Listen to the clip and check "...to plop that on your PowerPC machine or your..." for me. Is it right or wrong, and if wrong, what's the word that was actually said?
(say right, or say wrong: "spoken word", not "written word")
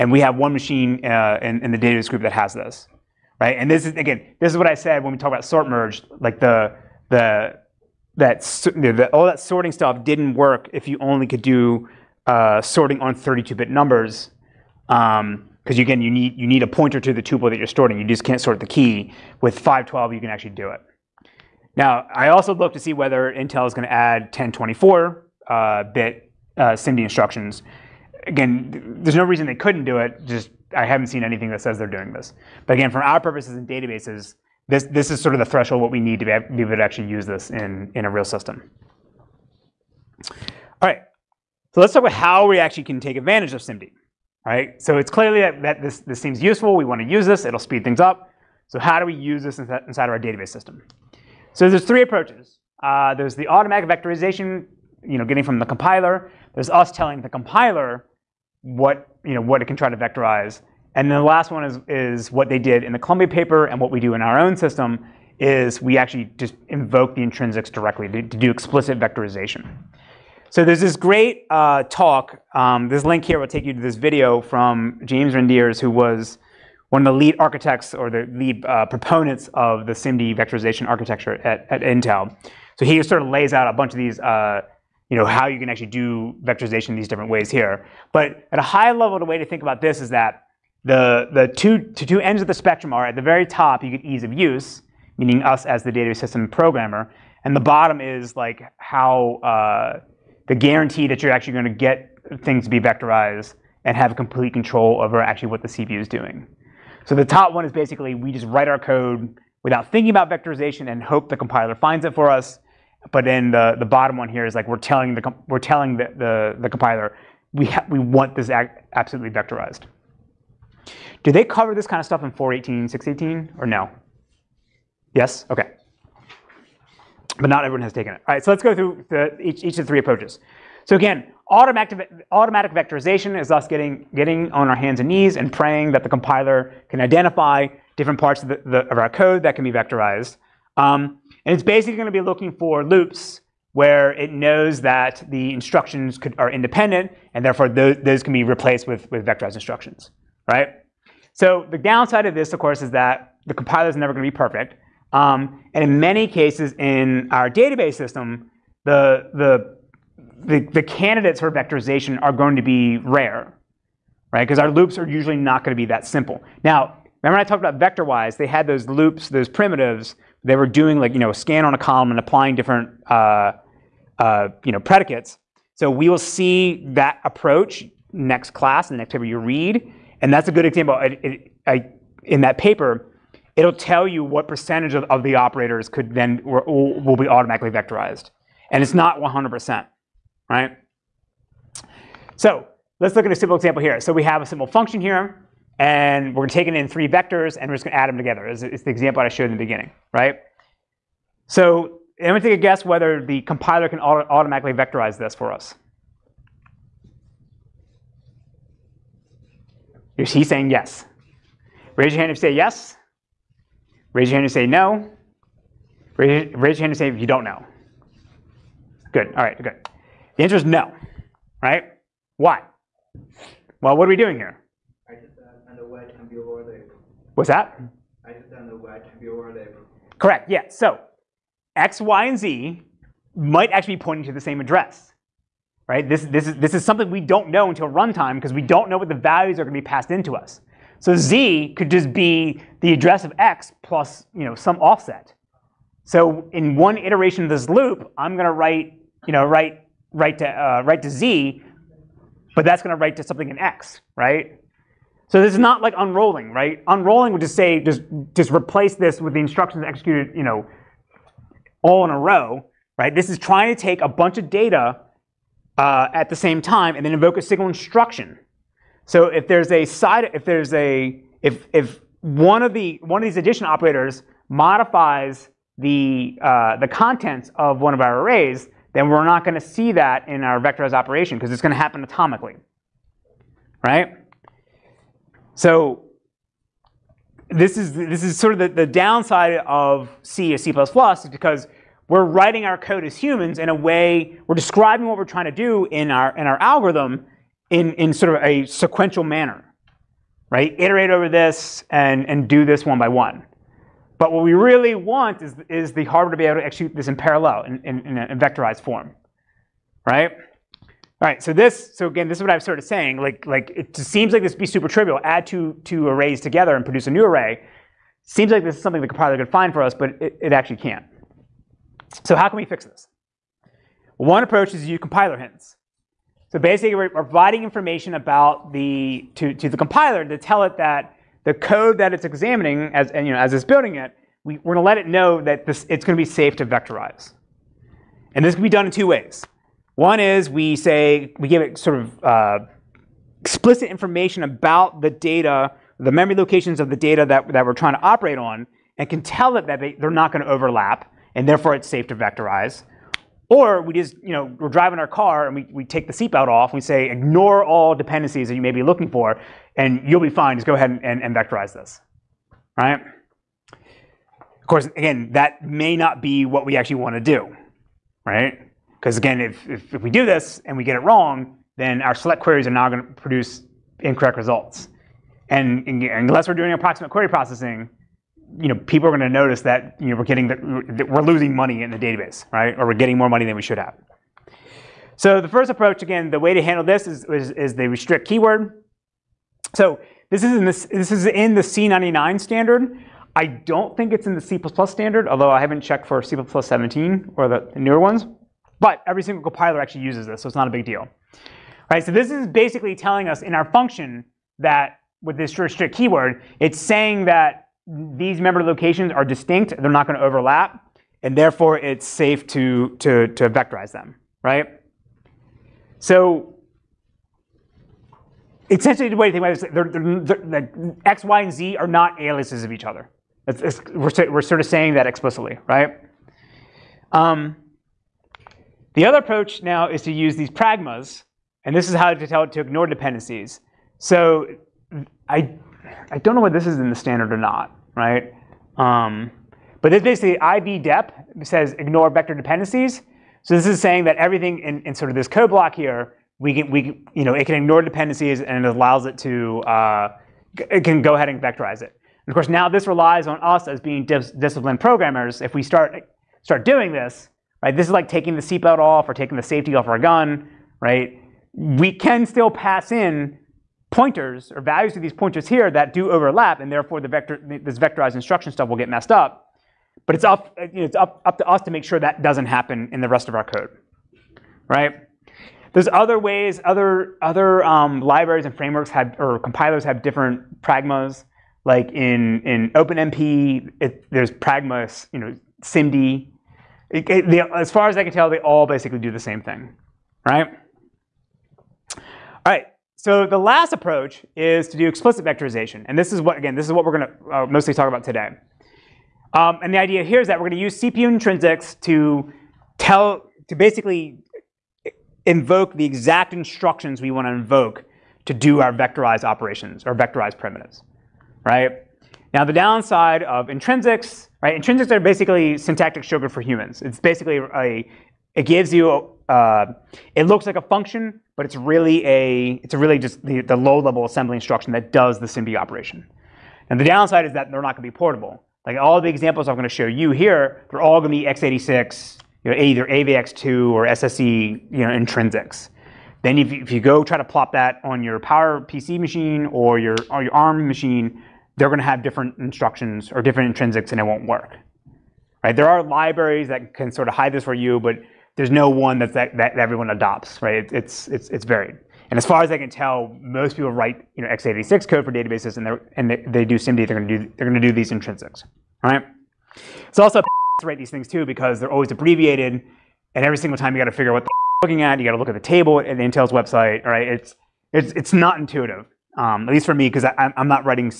right.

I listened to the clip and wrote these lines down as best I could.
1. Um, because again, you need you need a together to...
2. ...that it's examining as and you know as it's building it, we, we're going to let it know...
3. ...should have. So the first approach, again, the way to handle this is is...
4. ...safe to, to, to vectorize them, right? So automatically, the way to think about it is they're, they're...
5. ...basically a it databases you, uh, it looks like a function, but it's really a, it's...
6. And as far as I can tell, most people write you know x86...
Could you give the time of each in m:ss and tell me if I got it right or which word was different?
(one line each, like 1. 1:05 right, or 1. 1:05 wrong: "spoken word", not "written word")
1. 0:14 wrong: "pointer", not "together"
2. 5:31 right
3. 6:23 right
4. 6:52 wrong: "essentially", not "automatically"
5. 8:36 wrong: "gives", not "databases"
6. 9:12 right.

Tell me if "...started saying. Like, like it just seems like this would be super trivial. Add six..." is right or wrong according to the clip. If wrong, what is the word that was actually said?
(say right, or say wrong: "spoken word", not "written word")
wrong: "two", not "six".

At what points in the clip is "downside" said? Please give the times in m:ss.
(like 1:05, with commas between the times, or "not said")
2:31, 4:48, 8:32, 8:46.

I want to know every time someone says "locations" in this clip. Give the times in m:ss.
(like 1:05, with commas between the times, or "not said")
5:46, 6:48.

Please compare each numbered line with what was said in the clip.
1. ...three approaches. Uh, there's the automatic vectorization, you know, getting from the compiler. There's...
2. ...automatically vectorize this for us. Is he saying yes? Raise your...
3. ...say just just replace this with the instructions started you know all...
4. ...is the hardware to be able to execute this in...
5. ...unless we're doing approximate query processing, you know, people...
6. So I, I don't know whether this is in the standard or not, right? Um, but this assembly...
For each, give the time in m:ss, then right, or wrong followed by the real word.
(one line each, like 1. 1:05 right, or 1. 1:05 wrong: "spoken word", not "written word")
1. 0:51 right
2. 3:24 right
3. 4:17 wrong: "executed", not "started"
4. 5:05 right
5. 6:16 right
6. 7:13 wrong: "basically", not "assembly".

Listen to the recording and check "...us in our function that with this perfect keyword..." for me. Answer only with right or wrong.
wrong.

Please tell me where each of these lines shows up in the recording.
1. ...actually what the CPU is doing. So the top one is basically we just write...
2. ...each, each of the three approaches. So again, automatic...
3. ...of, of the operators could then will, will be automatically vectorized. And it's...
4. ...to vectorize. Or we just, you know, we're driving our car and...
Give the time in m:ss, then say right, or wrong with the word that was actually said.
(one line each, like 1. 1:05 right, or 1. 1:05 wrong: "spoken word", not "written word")
1. 1:45 right
2. 2:09 right
3. 3:04 right
4. 5:52 right.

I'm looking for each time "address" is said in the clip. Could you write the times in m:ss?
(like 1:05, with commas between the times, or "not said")
3:54, 4:02.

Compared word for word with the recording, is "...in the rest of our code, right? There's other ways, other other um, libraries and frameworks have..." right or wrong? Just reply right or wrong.
right.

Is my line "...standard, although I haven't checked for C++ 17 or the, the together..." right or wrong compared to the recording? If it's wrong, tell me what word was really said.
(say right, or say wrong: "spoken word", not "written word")
wrong: "newer", not "together".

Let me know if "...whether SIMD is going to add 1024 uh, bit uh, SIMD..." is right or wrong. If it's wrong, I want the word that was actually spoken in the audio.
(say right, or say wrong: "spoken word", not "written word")
wrong: "Intel", not "SIMD".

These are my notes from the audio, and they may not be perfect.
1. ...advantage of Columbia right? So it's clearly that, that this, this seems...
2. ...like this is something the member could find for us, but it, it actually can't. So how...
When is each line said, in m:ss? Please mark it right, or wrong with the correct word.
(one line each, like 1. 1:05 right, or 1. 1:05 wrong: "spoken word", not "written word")
1. 0:43 wrong: "SIMD", not "Columbia"
2. 5:18 wrong: "compiler", not "member".